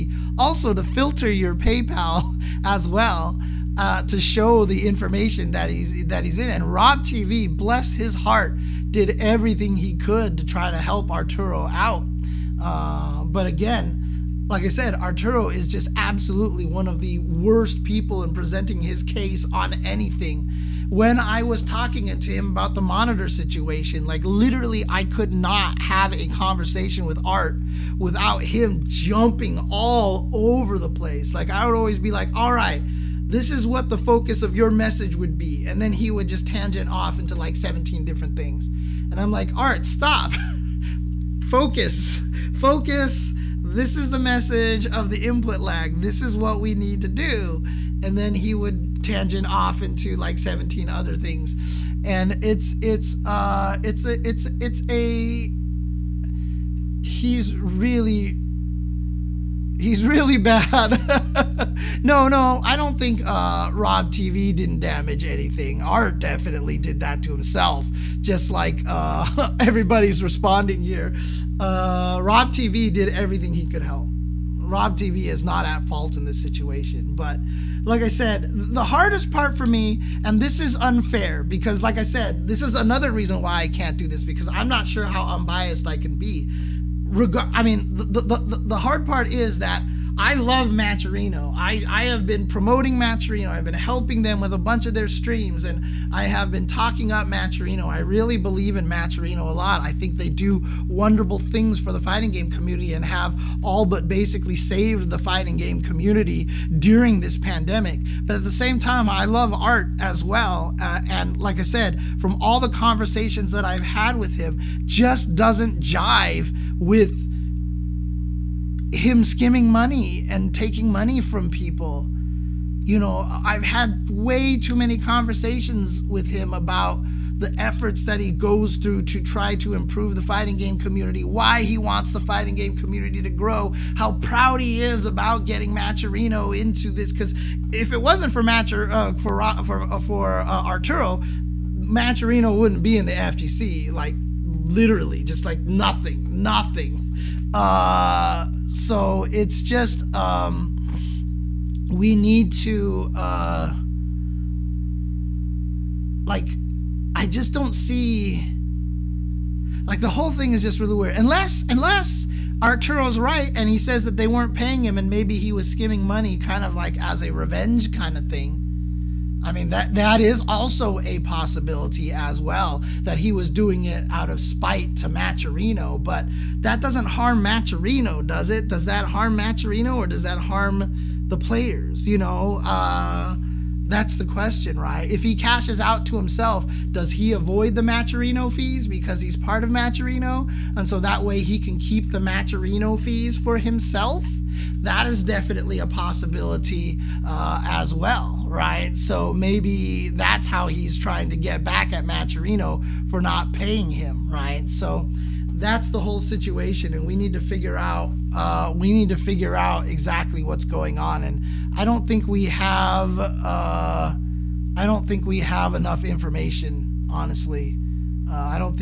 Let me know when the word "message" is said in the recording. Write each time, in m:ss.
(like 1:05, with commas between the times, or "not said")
0:34, 0:44.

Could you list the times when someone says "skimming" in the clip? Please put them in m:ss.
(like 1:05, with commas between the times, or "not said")
1:59, 2:45.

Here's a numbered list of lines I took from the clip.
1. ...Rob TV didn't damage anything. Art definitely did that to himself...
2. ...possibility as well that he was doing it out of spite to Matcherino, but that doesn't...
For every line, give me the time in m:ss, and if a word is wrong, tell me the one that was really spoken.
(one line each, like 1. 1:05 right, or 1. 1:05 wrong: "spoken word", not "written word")
1. 1:03 right
2. 2:51 right.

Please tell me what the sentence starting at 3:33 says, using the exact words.
Uh, I don't think we have enough information, honestly.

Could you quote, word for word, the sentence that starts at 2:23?
Like literally, just like nothing, nothing.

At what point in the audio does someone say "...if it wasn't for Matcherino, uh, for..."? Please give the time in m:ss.
2:17.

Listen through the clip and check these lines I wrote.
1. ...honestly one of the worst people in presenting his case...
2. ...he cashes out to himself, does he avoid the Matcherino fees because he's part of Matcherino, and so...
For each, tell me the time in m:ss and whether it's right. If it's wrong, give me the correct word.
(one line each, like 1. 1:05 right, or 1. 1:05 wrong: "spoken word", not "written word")
1. 0:15 wrong: "absolutely", not "honestly"
2. 3:05 right.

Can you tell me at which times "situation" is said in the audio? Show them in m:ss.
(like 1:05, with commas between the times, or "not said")
0:23, 1:16, 3:26.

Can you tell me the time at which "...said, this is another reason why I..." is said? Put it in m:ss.
1:22.